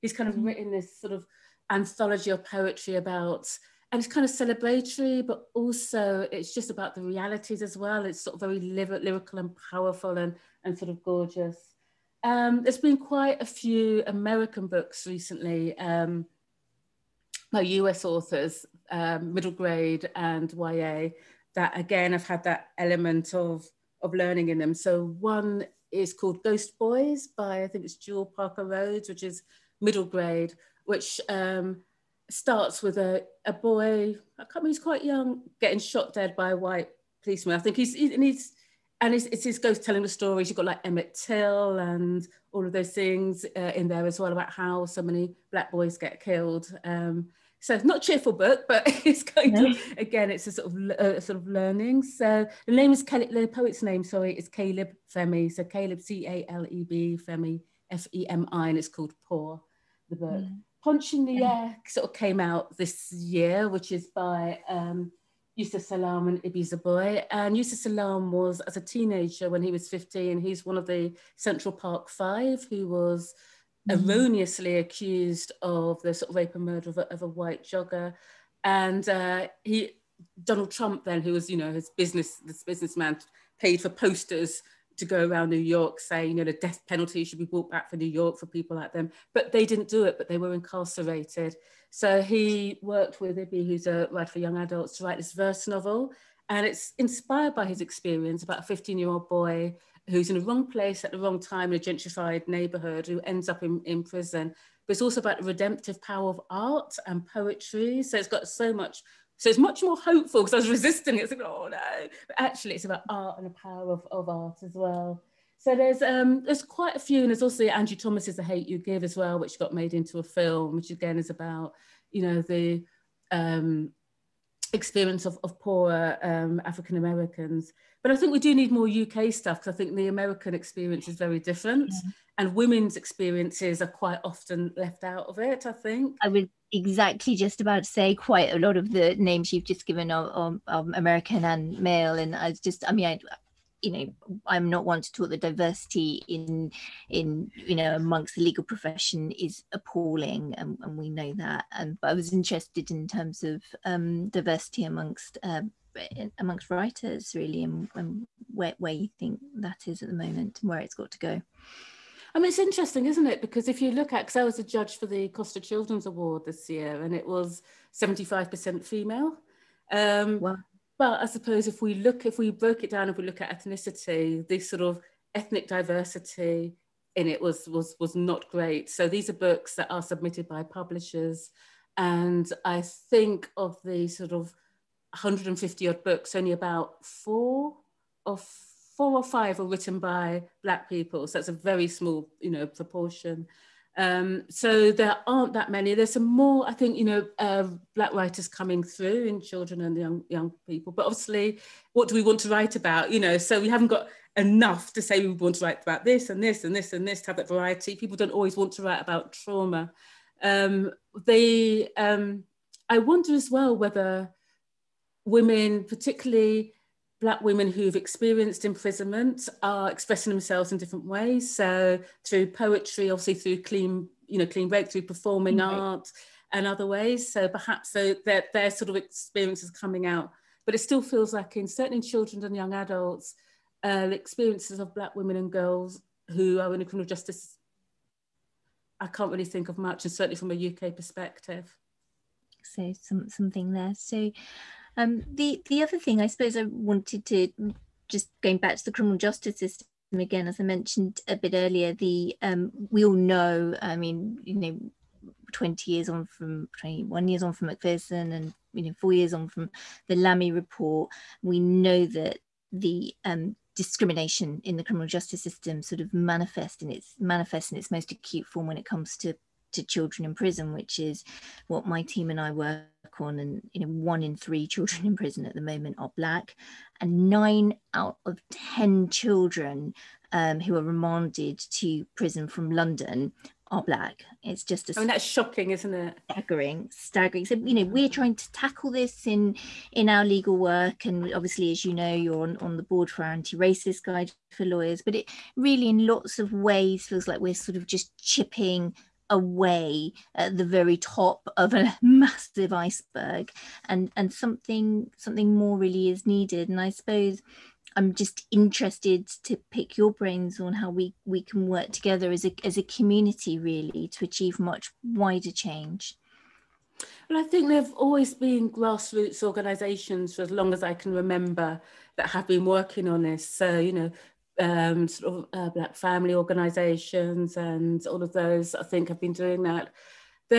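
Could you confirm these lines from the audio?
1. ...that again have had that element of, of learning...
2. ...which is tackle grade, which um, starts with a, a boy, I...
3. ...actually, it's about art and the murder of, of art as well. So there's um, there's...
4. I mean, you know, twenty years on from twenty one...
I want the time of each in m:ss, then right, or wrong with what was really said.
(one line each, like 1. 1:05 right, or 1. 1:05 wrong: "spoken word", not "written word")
1. 0:21 right
2. 0:29 wrong: "middle", not "tackle"
3. 1:52 wrong: "power", not "murder"
4. 4:13 right.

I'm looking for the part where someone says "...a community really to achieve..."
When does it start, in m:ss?
5:12.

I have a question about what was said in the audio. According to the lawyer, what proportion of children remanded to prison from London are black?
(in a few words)
9 out of 10.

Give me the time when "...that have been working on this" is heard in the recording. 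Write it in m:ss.
5:22.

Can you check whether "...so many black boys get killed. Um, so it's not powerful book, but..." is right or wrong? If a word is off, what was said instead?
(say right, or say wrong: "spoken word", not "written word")
wrong: "cheerful", not "powerful".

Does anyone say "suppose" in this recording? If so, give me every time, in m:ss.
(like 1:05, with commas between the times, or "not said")
2:51, 4:06, 5:06.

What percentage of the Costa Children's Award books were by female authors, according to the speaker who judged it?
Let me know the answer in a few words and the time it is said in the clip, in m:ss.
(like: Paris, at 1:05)
75%, at 2:47.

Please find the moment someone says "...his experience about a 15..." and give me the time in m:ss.
1:37.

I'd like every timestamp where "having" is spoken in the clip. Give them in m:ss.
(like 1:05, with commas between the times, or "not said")
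not said.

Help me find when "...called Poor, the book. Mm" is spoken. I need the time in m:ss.
0:58.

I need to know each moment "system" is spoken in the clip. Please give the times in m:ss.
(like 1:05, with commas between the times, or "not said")
4:09, 4:25.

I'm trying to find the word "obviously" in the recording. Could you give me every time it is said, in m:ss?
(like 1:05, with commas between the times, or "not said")
3:21, 3:43, 4:51.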